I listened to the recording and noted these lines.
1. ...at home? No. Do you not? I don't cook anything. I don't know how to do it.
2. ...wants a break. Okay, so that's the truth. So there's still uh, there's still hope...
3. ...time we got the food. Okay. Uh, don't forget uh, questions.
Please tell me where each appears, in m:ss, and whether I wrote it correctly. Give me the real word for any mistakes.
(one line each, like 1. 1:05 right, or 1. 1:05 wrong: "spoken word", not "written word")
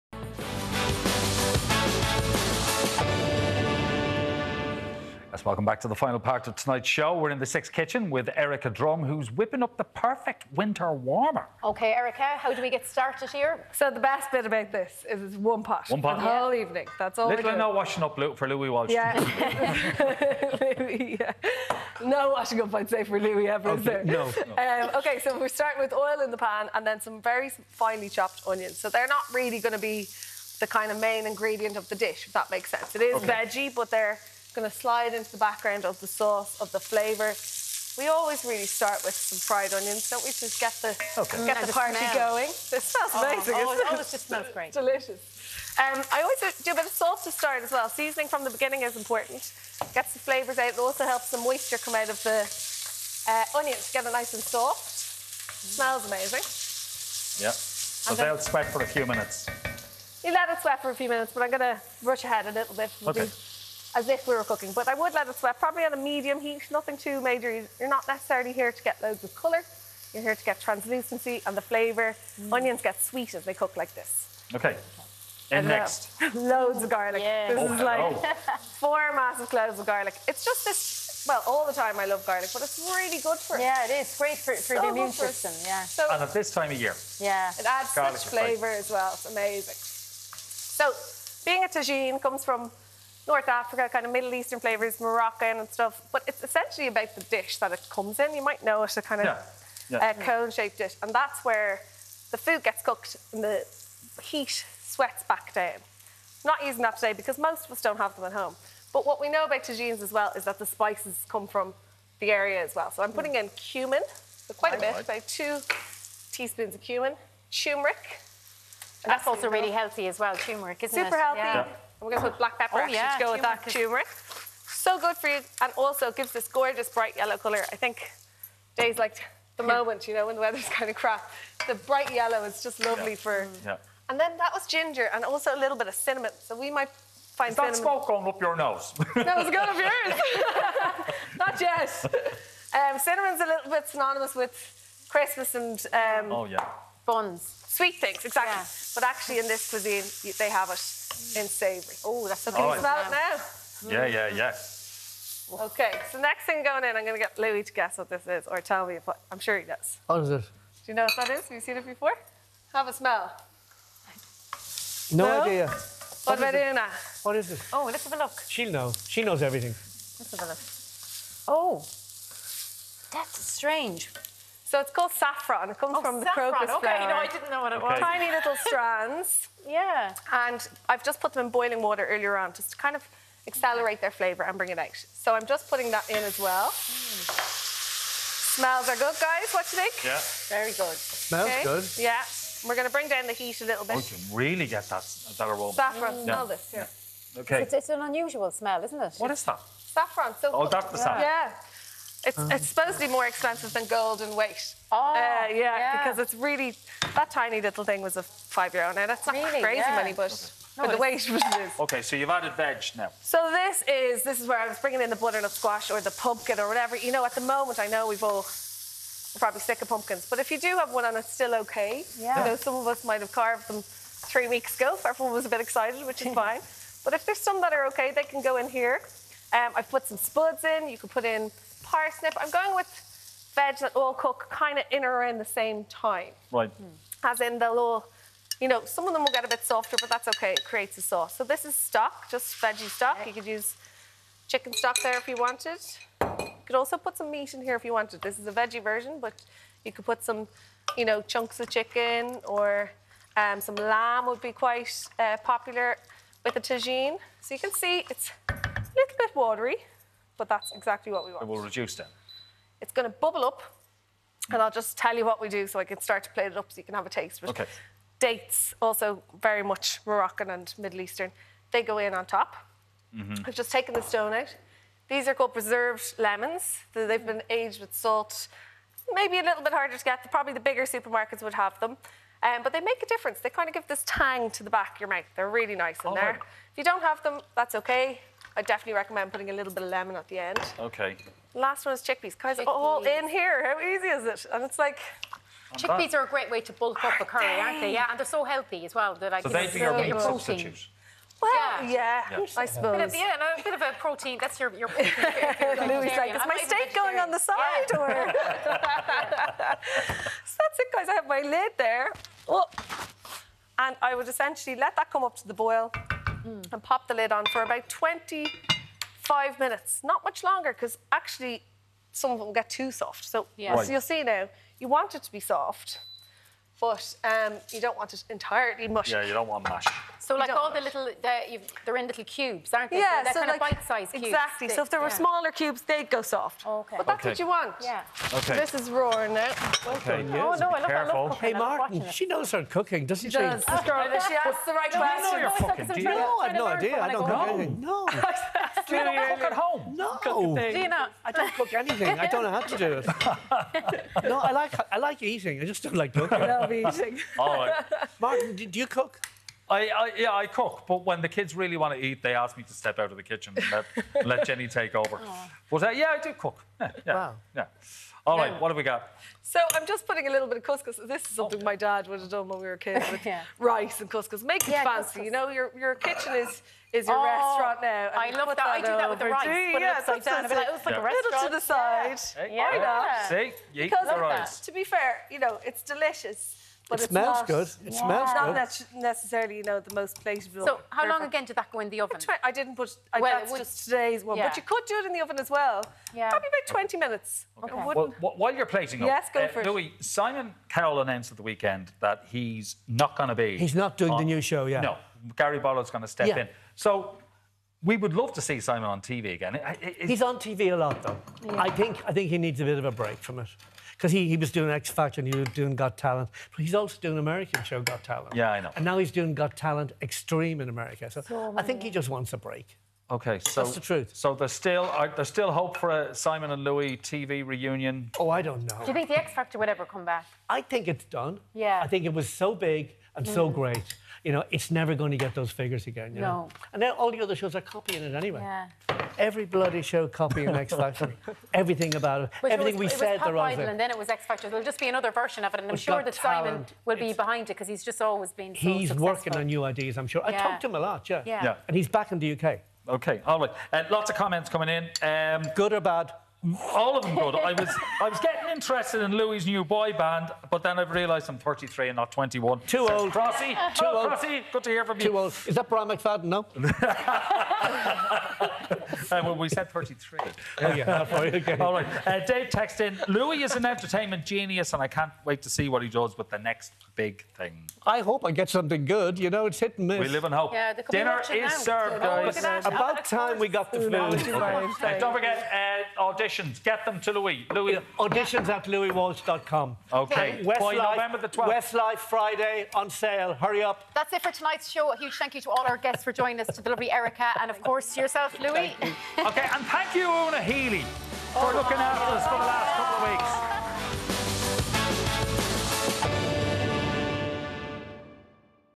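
1. 5:49 right
2. 7:02 right
3. 8:03 wrong: "auditions", not "questions".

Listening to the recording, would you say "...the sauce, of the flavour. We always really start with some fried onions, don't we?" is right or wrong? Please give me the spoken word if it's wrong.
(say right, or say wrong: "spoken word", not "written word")
right.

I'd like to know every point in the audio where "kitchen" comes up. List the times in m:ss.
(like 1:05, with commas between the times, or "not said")
0:07, 6:03, 6:15.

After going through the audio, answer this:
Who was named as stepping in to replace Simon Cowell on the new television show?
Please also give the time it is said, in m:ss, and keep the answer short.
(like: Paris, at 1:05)
Gary Barlow, at 6:45.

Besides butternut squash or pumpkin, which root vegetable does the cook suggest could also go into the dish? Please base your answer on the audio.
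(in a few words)
Parsnip.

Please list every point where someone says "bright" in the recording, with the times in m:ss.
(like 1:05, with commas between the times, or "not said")
2:06, 2:11.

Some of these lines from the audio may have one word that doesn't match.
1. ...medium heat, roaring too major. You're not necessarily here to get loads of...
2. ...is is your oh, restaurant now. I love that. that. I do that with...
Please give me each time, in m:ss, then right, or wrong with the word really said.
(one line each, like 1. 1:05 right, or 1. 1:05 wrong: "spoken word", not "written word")
1. 1:05 wrong: "nothing", not "roaring"
2. 6:16 right.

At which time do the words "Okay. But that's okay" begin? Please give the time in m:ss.
5:36.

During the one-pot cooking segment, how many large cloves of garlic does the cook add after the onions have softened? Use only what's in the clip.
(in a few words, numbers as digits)
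4.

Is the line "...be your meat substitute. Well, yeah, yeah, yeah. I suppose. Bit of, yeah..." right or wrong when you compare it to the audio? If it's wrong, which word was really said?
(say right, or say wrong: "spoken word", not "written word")
right.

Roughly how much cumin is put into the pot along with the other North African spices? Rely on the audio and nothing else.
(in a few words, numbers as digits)
2 teaspoons.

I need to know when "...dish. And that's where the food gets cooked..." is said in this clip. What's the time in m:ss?
1:40.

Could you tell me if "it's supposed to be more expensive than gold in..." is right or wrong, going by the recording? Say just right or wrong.
right.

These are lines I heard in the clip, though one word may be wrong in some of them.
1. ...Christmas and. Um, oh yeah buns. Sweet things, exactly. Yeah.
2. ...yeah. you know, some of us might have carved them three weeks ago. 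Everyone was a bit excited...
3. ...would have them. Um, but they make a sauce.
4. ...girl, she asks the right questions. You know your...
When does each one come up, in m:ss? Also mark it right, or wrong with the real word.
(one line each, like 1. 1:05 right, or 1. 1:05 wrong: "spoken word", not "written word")
1. 2:25 right
2. 3:42 right
3. 4:41 wrong: "difference", not "sauce"
4. 5:43 right.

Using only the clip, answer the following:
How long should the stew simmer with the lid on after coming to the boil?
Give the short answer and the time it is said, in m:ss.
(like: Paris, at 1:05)
25 minutes, at 5:17.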